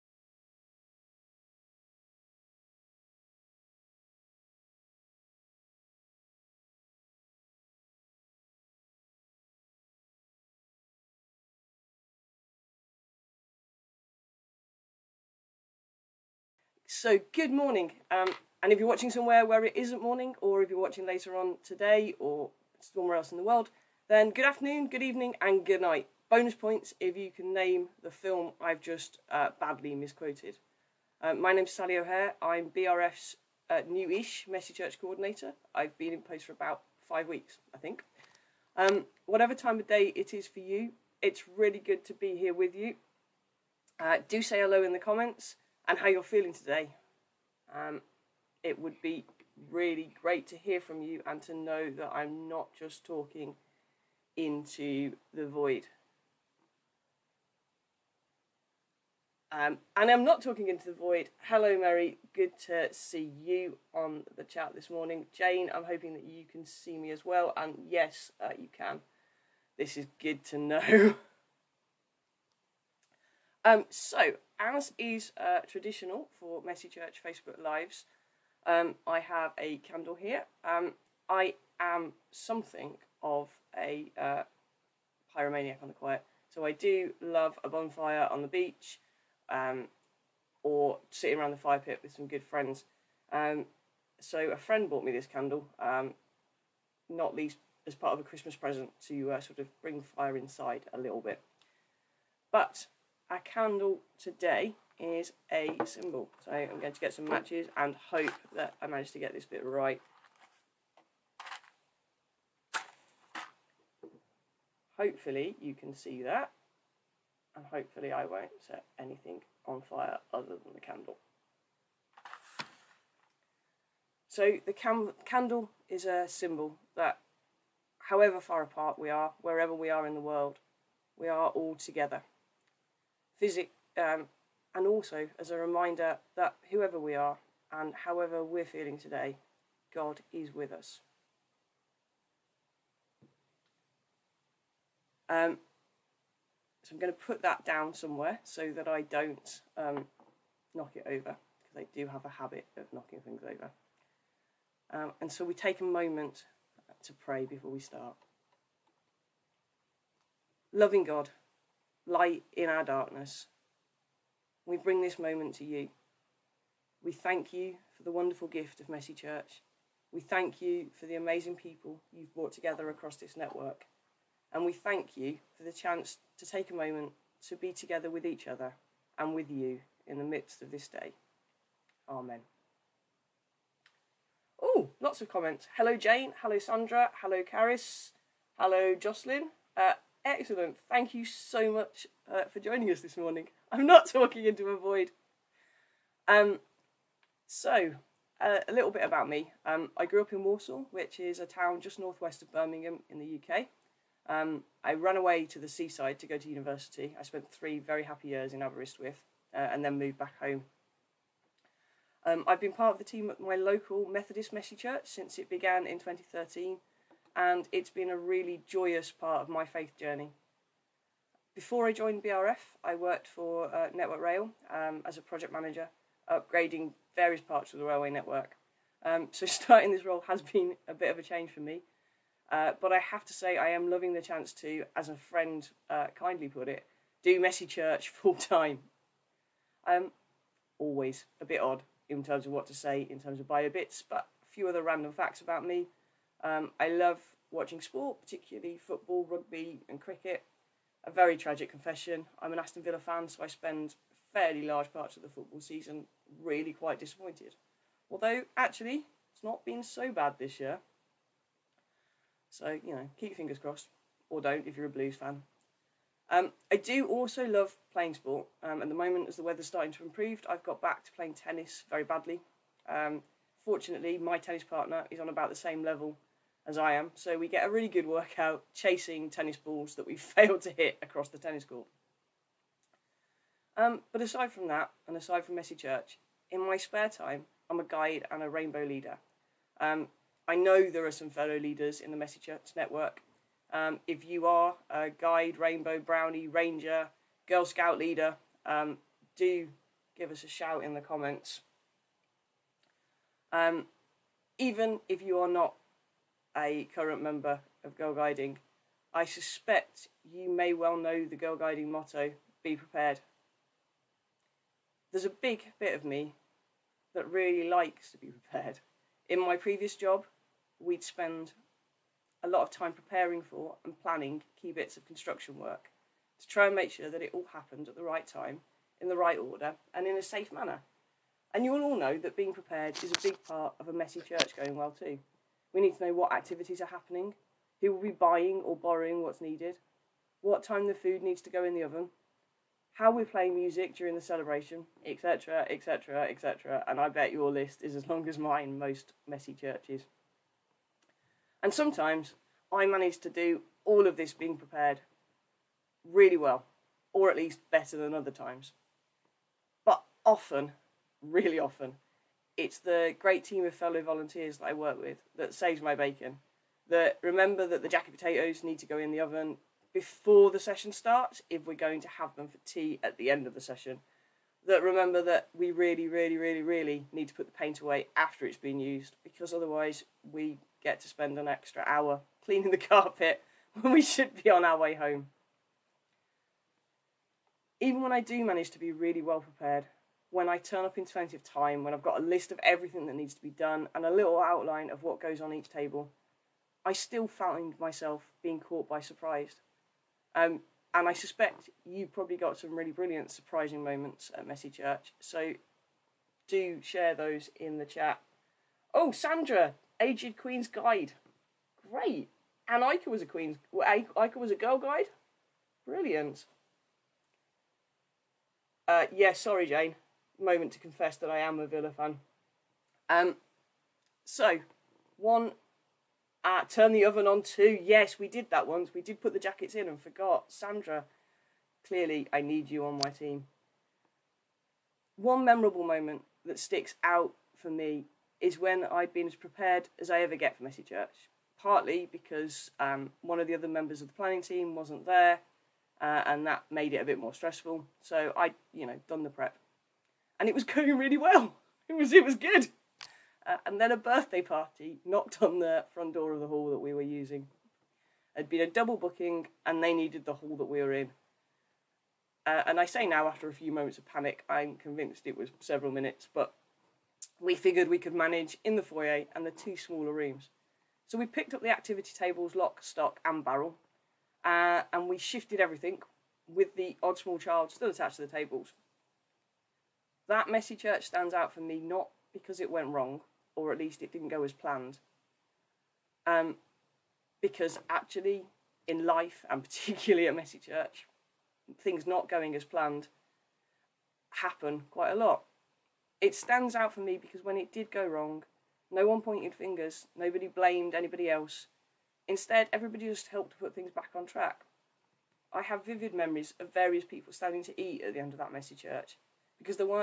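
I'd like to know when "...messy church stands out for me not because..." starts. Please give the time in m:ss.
8:00.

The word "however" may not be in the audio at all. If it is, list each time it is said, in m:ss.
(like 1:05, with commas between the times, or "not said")
2:08, 2:17.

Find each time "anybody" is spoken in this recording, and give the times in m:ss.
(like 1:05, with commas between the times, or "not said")
8:20.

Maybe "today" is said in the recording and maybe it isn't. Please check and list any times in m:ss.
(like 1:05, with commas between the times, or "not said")
0:21, 0:46, 1:44, 2:18.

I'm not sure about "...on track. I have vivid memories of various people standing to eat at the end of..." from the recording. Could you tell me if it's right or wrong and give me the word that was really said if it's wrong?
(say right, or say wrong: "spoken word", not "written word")
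right.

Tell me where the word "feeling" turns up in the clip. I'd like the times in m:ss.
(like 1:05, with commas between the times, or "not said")
0:46, 2:18.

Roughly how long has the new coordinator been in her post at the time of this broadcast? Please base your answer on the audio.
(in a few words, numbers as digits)
5 weeks.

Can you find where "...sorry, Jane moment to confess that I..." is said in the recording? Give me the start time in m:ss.
6:59.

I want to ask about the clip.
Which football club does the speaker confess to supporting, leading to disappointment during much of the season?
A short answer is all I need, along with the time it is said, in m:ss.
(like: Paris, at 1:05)
Aston Villa, at 4:12.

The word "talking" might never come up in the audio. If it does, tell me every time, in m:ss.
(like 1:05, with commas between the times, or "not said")
0:53, 1:00, 3:14.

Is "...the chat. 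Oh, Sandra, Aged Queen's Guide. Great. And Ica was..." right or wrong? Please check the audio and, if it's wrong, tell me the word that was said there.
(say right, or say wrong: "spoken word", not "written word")
right.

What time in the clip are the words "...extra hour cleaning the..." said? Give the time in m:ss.
6:21.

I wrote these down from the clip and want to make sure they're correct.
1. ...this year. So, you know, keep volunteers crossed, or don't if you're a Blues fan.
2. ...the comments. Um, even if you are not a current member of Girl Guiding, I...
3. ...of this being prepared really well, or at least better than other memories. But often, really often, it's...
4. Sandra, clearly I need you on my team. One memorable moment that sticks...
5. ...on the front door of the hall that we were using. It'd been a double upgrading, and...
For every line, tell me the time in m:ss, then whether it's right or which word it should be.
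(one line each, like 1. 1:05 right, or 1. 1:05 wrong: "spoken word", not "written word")
1. 4:20 wrong: "fingers", not "volunteers"
2. 5:00 right
3. 5:54 wrong: "times", not "memories"
4. 7:10 right
5. 7:35 wrong: "booking", not "upgrading".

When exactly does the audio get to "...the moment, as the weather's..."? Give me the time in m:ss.
4:28.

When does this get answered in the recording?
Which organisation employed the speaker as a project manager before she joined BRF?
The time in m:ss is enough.
3:43.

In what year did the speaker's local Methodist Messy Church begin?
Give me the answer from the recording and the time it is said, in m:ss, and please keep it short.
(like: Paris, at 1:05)
2013, at 3:35.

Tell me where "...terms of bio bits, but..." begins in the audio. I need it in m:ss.
4:03.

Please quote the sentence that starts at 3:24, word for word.
Um, I ran away to the seaside to go to university.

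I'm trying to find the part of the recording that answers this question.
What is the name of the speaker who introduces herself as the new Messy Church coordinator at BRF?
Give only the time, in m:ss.
0:31.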